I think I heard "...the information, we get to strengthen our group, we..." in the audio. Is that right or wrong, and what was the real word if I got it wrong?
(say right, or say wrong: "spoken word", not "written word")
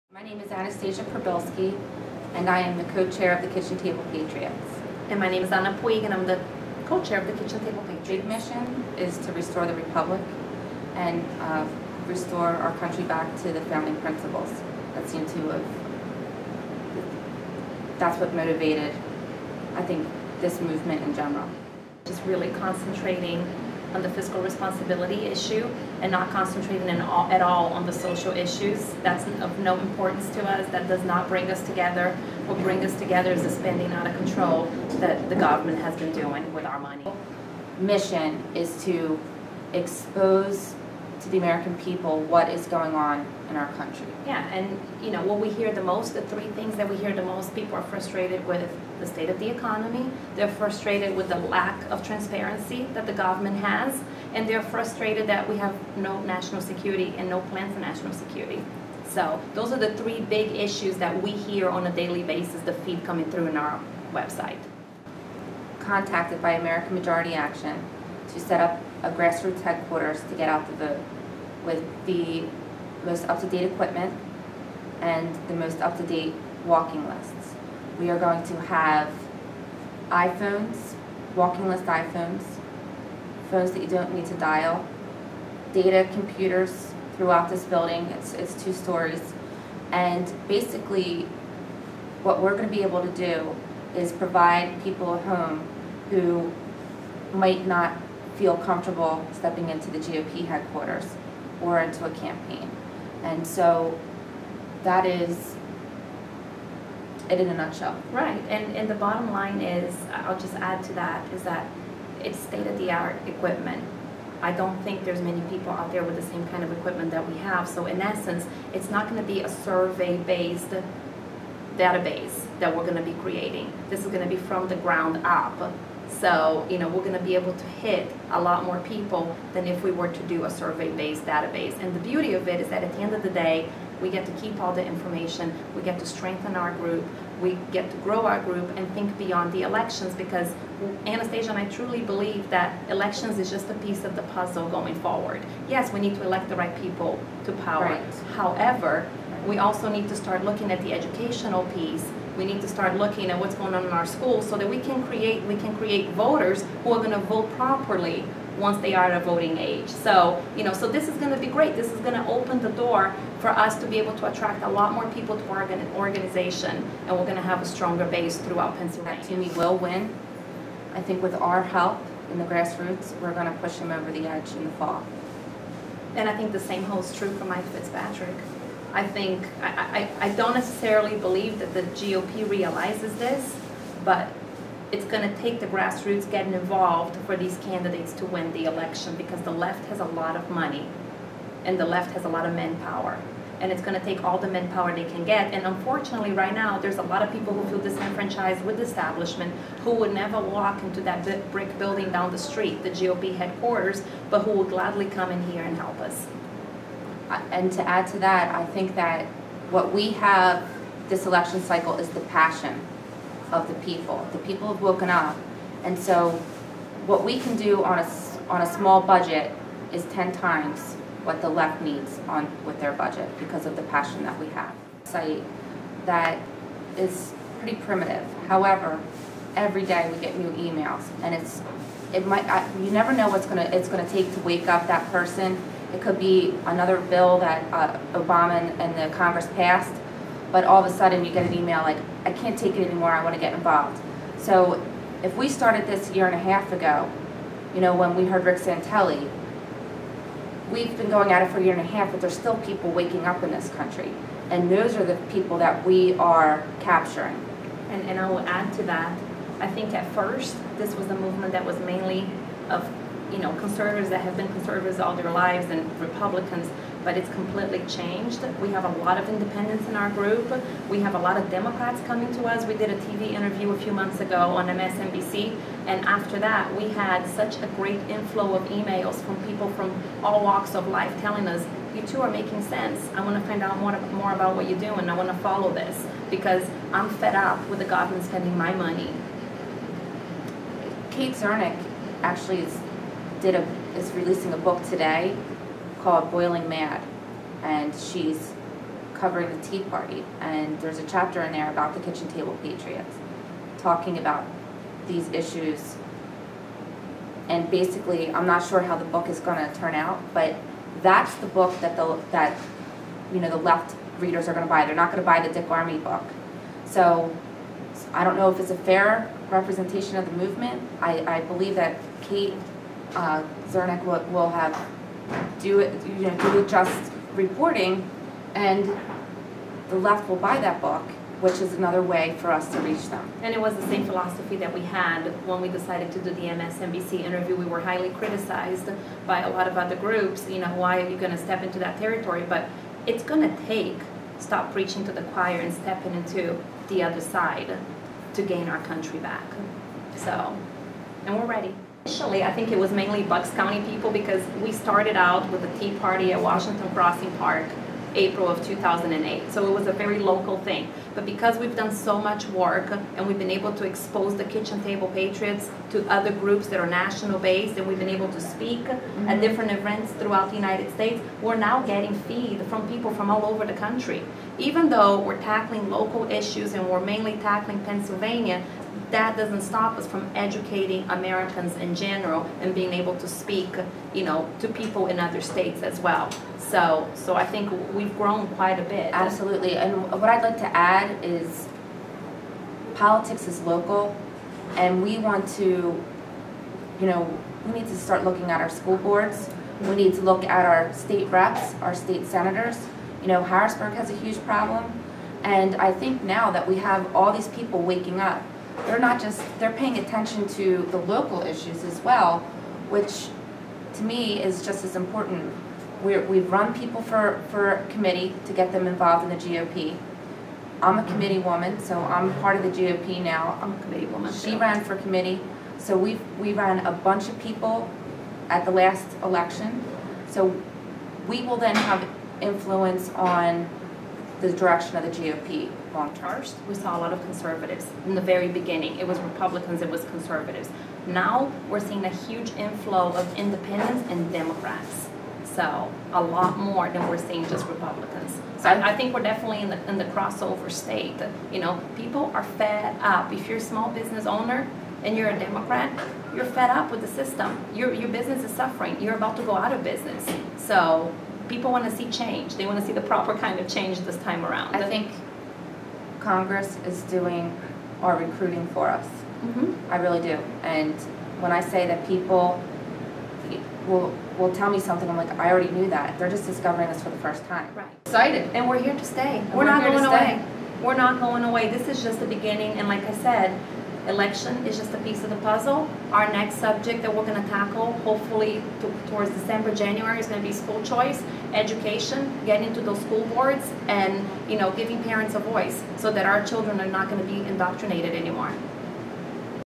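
right.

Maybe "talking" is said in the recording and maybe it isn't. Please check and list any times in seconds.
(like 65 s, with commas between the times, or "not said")
303 s.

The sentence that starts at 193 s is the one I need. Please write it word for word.
And it's going to take all the manpower they can get.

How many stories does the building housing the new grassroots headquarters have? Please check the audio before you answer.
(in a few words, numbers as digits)
2.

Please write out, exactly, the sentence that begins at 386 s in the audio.
So, so I think we've grown quite a bit.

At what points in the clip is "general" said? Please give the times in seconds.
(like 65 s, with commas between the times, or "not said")
21 s, 381 s.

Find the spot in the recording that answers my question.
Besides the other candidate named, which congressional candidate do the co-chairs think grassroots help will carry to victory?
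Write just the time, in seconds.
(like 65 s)
177 s.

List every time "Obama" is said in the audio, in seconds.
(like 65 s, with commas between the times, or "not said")
238 s.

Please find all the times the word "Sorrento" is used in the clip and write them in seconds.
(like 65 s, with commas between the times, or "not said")
not said.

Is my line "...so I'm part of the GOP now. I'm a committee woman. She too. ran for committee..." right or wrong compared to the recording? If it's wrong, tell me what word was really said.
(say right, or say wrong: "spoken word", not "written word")
right.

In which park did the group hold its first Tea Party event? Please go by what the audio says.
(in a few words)
Washington Crossing Park.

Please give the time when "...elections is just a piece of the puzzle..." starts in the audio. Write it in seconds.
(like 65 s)
142 s.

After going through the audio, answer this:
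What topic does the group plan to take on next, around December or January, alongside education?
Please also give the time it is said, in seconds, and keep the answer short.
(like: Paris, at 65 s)
school choice, at 490 s.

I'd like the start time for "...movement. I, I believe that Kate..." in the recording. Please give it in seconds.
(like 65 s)
320 s.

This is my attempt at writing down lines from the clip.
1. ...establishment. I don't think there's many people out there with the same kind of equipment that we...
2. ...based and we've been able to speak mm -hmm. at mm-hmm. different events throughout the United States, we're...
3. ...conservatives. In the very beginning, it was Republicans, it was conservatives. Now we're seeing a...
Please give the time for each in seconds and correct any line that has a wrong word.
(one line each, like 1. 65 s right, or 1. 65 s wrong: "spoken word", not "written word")
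1. 113 s wrong: "equipment", not "establishment"
2. 367 s right
3. 437 s right.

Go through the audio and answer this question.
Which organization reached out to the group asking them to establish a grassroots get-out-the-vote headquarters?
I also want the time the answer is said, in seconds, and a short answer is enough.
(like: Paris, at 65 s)
American Majority Action, at 66 s.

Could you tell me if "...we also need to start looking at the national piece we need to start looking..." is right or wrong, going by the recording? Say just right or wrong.
wrong.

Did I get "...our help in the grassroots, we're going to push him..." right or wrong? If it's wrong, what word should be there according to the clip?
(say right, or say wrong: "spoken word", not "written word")
right.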